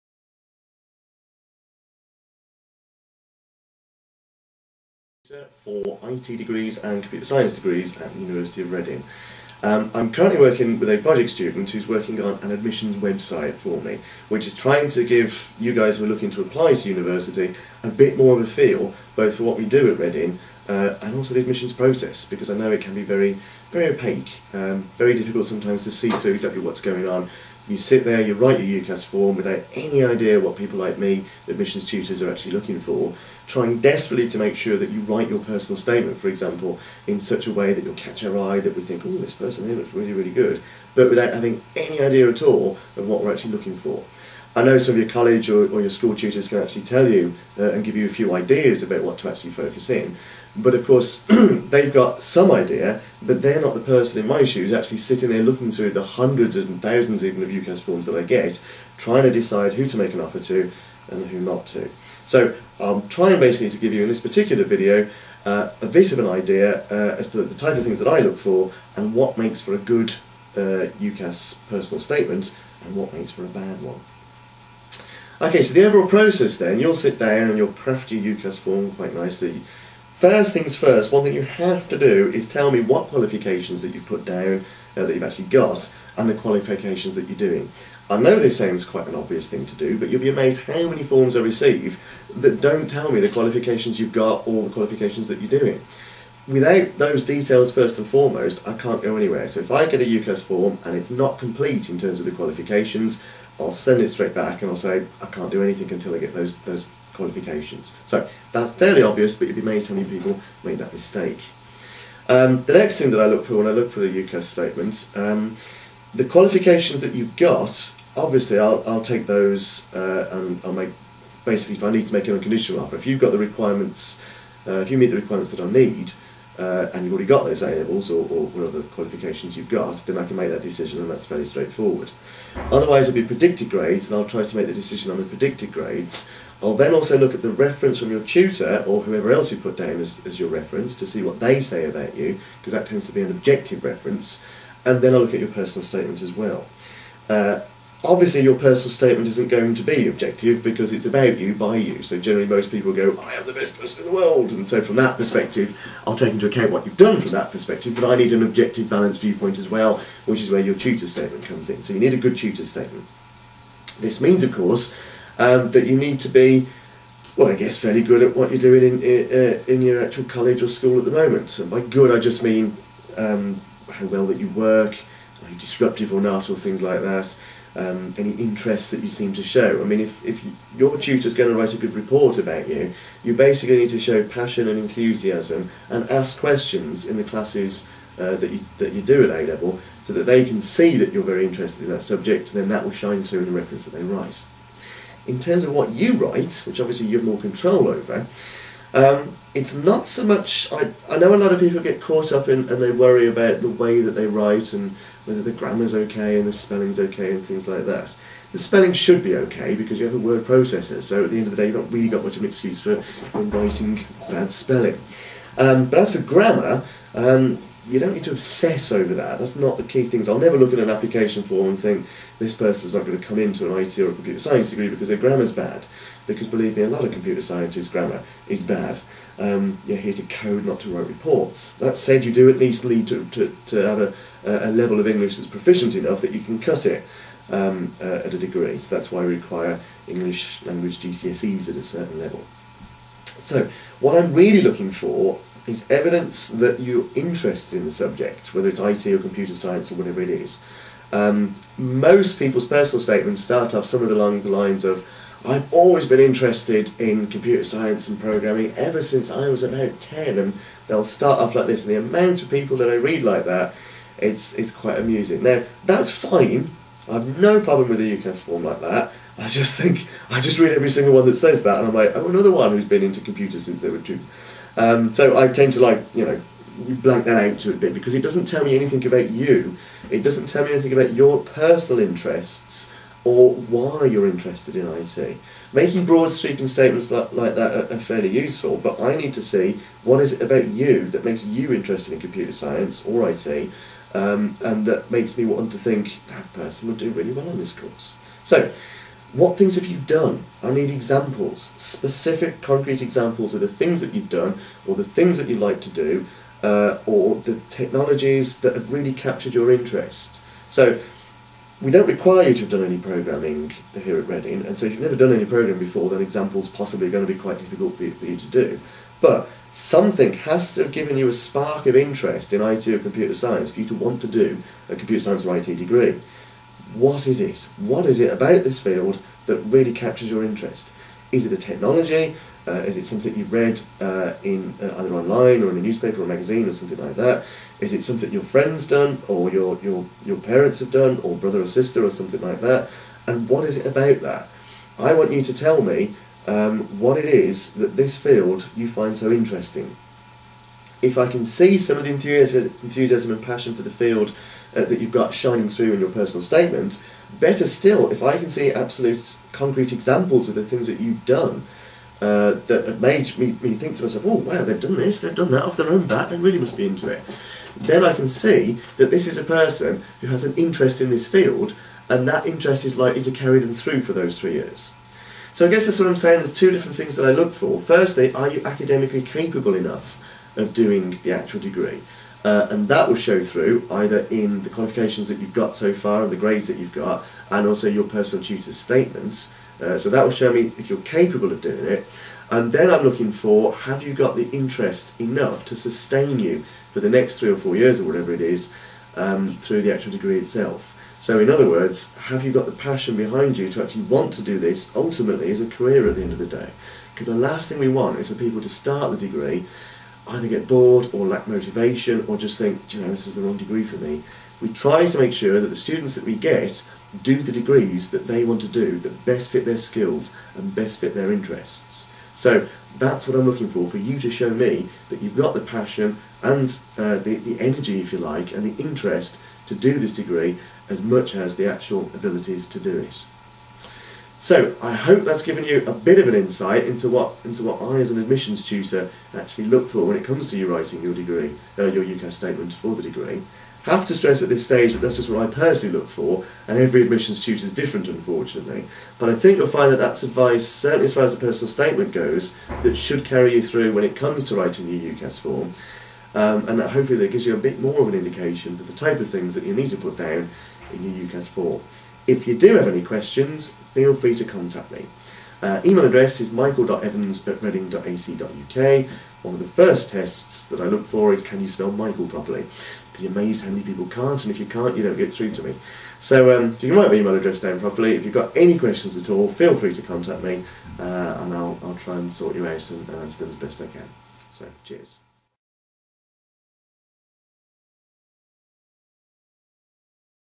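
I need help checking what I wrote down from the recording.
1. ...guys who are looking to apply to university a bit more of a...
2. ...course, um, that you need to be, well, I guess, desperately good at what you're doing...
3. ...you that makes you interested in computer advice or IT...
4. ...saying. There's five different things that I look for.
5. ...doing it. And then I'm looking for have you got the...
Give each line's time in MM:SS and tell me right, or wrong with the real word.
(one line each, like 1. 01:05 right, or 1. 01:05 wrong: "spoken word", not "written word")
1. 00:15 right
2. 02:44 wrong: "fairly", not "desperately"
3. 04:50 wrong: "science", not "advice"
4. 06:16 wrong: "two", not "five"
5. 06:31 right.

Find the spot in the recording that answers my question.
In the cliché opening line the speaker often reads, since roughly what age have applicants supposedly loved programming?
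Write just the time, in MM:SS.
04:19.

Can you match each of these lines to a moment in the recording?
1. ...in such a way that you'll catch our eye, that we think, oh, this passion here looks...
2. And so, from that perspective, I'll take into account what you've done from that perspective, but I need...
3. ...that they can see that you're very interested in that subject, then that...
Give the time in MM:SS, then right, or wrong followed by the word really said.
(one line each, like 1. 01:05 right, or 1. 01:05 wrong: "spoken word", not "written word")
1. 00:37 wrong: "person", not "passion"
2. 02:34 right
3. 03:10 right.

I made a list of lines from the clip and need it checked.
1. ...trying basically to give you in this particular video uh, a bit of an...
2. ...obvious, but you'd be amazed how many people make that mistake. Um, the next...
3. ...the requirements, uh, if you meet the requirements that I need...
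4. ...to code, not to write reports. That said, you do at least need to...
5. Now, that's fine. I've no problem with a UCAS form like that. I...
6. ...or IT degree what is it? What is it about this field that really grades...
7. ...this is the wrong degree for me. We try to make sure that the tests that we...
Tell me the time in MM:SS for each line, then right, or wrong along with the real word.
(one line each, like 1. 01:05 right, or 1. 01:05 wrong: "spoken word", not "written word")
1. 01:03 right
2. 01:49 right
3. 02:03 right
4. 03:50 right
5. 04:25 right
6. 05:25 wrong: "captures", not "grades"
7. 06:53 wrong: "students", not "tests".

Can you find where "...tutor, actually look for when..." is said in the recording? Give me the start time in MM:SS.
07:18.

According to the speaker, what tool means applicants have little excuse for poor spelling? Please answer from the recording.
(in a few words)
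A word processor.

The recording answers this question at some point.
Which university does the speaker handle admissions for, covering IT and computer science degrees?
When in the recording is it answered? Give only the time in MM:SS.
00:08.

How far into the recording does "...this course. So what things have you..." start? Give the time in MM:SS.
04:57.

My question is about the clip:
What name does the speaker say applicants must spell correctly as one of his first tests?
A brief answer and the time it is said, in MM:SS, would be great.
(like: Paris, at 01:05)
Michael, at 07:51.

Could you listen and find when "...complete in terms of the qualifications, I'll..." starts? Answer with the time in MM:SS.
01:41.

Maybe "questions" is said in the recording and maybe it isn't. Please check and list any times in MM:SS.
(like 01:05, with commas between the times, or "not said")
03:06, 07:43, 07:58.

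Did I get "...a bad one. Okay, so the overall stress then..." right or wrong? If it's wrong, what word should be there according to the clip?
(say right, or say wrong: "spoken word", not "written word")
wrong: "process", not "stress".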